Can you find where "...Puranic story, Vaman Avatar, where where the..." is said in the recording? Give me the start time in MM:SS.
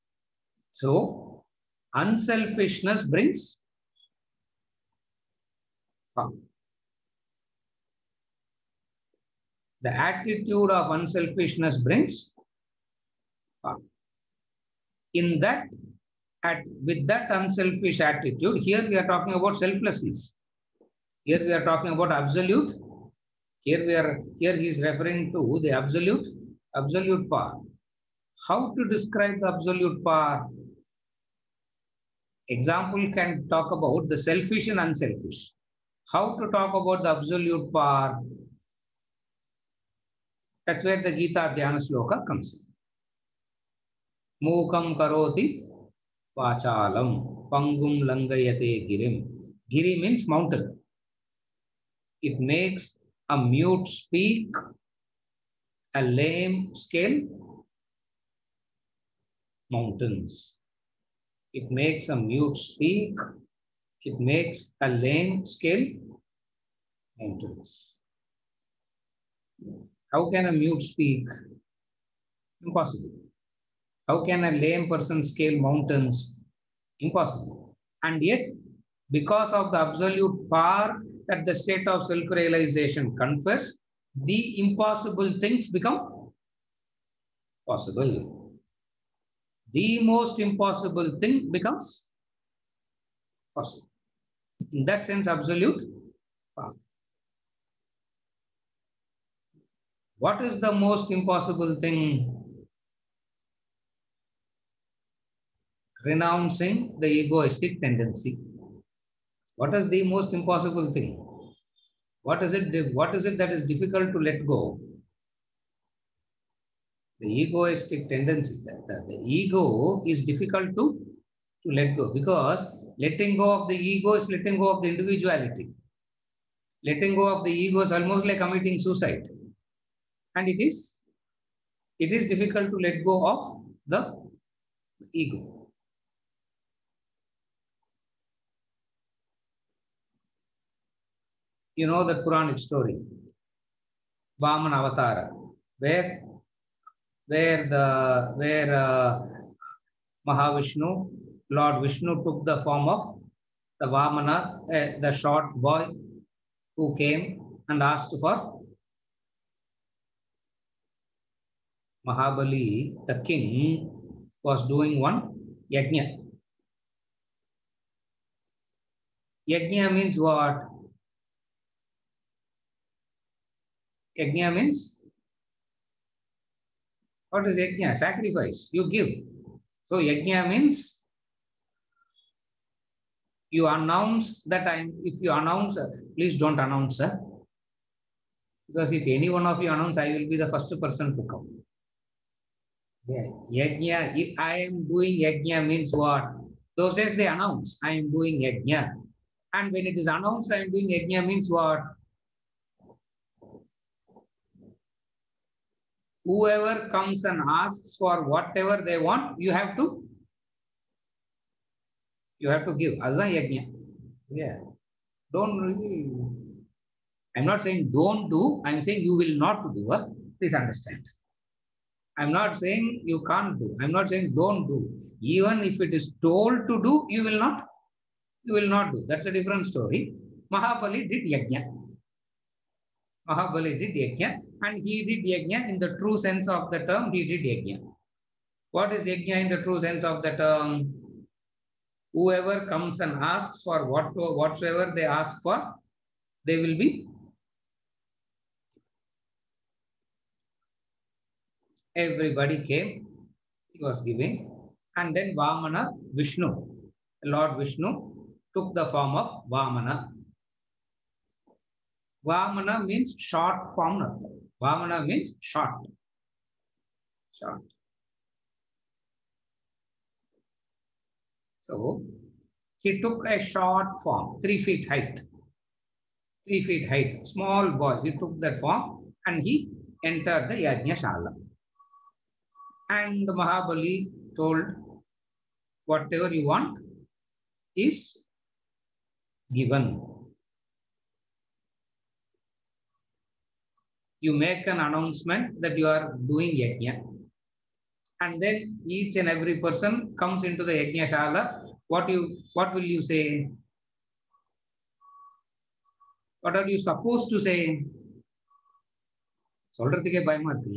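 02:22.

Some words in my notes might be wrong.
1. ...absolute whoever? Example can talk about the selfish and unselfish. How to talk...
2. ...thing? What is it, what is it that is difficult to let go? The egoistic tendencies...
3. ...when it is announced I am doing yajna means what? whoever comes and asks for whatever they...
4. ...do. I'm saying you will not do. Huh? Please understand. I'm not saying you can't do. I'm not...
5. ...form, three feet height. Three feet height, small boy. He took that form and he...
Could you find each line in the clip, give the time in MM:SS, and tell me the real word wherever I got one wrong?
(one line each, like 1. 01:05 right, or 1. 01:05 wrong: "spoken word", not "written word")
1. 00:29 wrong: "power", not "whoever"
2. 01:50 right
3. 03:19 right
4. 03:38 right
5. 04:34 right.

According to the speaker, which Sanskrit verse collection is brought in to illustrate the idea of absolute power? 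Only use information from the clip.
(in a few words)
Gita Dhyana Sloka.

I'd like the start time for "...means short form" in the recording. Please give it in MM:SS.
04:22.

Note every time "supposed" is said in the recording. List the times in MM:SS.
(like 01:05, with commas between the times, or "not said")
05:06.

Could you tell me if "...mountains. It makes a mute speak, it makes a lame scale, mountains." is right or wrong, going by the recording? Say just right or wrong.
right.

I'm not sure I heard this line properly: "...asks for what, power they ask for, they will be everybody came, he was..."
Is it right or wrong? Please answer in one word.
wrong.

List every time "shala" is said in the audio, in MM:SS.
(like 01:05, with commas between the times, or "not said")
04:40, 05:01.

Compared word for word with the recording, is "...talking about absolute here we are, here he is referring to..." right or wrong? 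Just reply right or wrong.
right.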